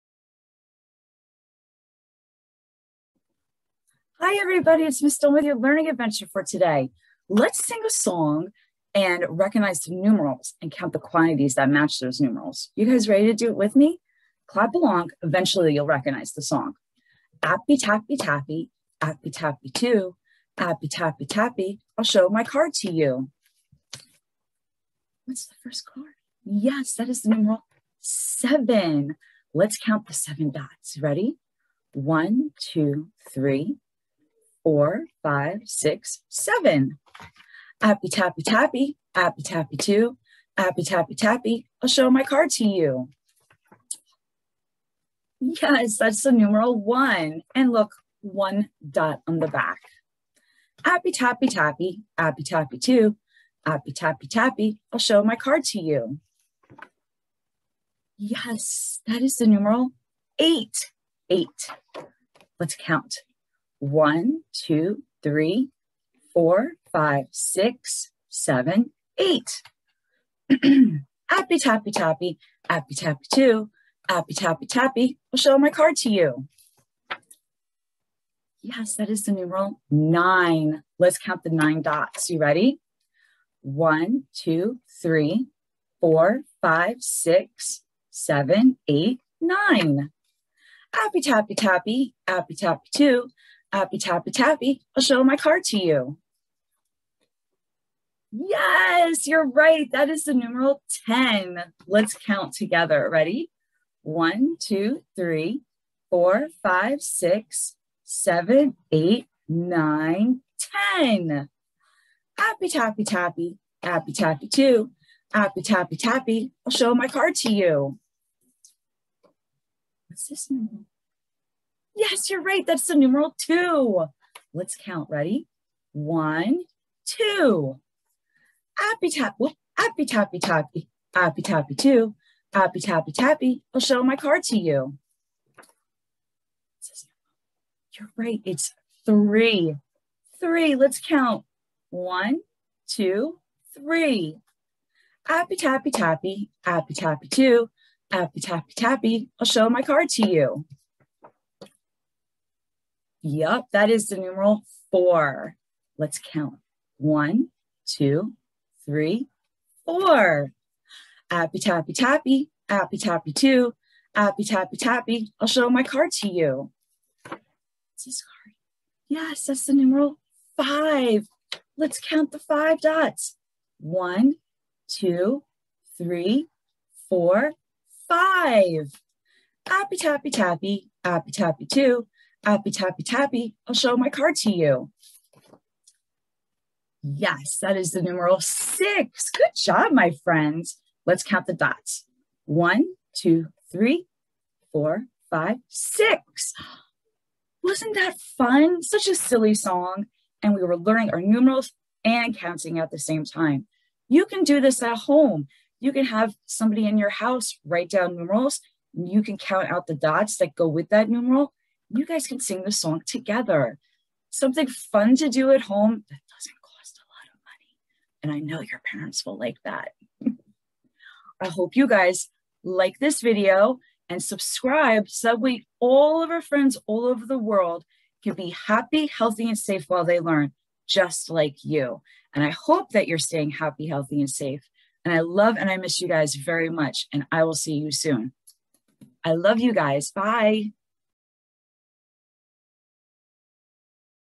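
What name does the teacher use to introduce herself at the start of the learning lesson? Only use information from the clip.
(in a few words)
Miss Dawn.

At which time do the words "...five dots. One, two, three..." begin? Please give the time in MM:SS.
02:52.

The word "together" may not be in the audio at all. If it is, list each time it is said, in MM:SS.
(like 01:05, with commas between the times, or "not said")
01:42, 03:33.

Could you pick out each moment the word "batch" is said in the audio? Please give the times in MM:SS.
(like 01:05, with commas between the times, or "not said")
not said.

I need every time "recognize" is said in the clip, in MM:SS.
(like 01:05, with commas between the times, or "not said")
00:09, 00:15.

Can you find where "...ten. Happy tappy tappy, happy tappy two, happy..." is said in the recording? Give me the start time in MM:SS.
01:50.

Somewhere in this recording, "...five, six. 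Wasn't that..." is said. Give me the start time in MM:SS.
03:15.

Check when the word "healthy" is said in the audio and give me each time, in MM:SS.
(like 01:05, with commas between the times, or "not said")
03:49, 03:53.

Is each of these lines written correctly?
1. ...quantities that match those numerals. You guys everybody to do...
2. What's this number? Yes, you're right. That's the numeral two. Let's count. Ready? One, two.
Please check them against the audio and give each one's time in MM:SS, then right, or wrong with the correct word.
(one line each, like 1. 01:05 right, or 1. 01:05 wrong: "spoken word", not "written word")
1. 00:10 wrong: "ready", not "everybody"
2. 02:00 right.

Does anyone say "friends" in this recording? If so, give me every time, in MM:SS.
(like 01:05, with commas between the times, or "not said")
03:10, 03:46.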